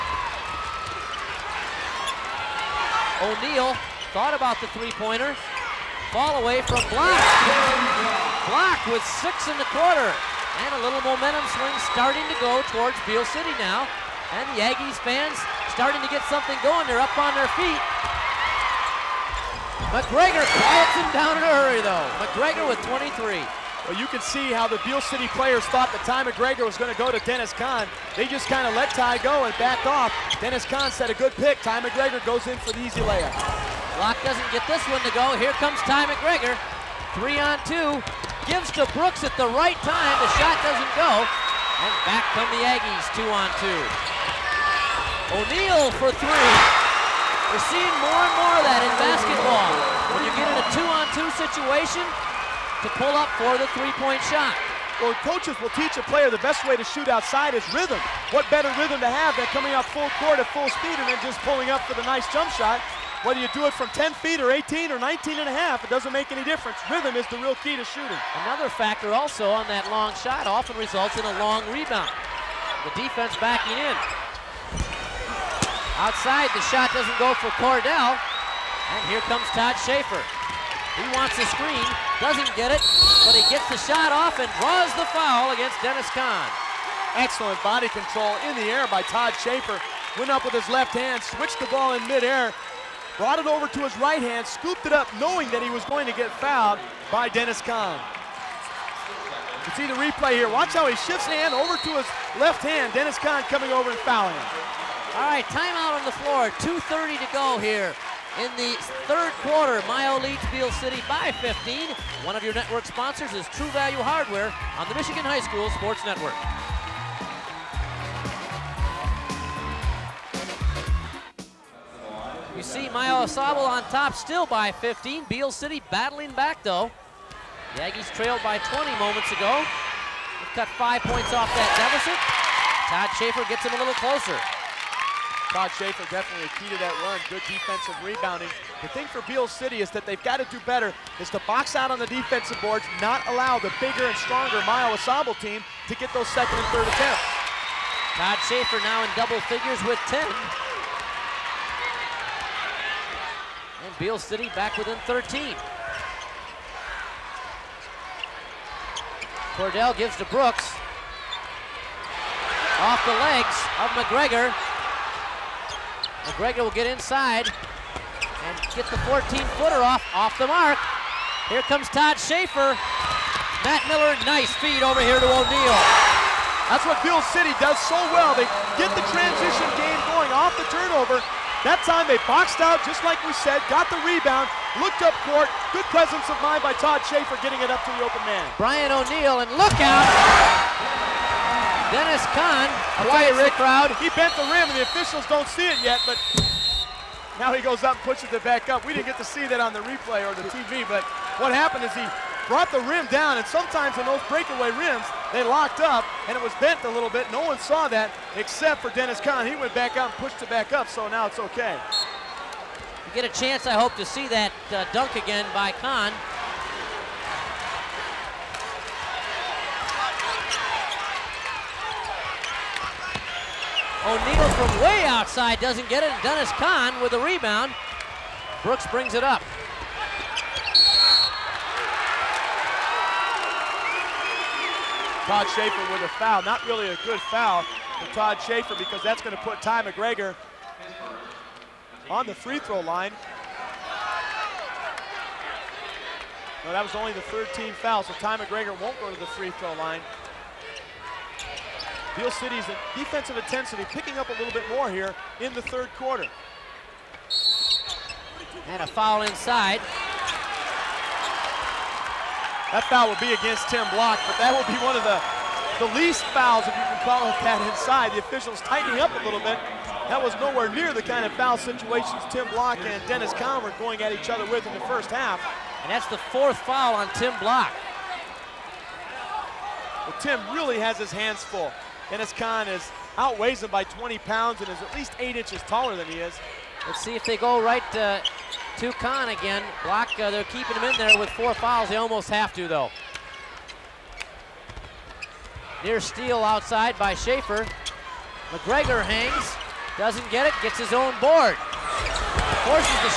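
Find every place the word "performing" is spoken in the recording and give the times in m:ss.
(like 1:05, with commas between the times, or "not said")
not said.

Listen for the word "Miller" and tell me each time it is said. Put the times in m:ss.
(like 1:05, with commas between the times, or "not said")
2:53.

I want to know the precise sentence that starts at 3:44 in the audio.
O'Neal from way outside doesn't get it.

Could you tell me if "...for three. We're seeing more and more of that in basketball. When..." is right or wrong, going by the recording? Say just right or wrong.
right.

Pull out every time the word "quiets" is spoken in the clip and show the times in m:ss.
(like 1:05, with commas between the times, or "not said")
0:20, 3:13.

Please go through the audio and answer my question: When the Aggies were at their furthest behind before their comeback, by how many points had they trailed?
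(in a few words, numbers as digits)
20.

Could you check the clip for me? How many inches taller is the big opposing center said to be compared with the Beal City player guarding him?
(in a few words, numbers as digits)
8.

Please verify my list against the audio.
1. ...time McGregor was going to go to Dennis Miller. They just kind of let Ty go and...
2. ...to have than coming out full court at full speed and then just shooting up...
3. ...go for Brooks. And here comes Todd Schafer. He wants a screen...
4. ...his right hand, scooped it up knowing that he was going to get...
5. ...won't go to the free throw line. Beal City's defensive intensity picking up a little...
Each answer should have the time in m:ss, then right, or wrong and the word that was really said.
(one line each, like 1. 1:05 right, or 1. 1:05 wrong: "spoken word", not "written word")
1. 0:26 wrong: "Kann", not "Miller"
2. 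0:58 wrong: "pulling", not "shooting"
3. 1:17 wrong: "Cordell", not "Brooks"
4. 1:33 right
5. 4:08 right.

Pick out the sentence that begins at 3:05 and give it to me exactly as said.
Good presence of mind by Todd Schafer getting it up to the open man.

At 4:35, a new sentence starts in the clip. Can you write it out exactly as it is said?
And that's the fourth foul on Tim Block.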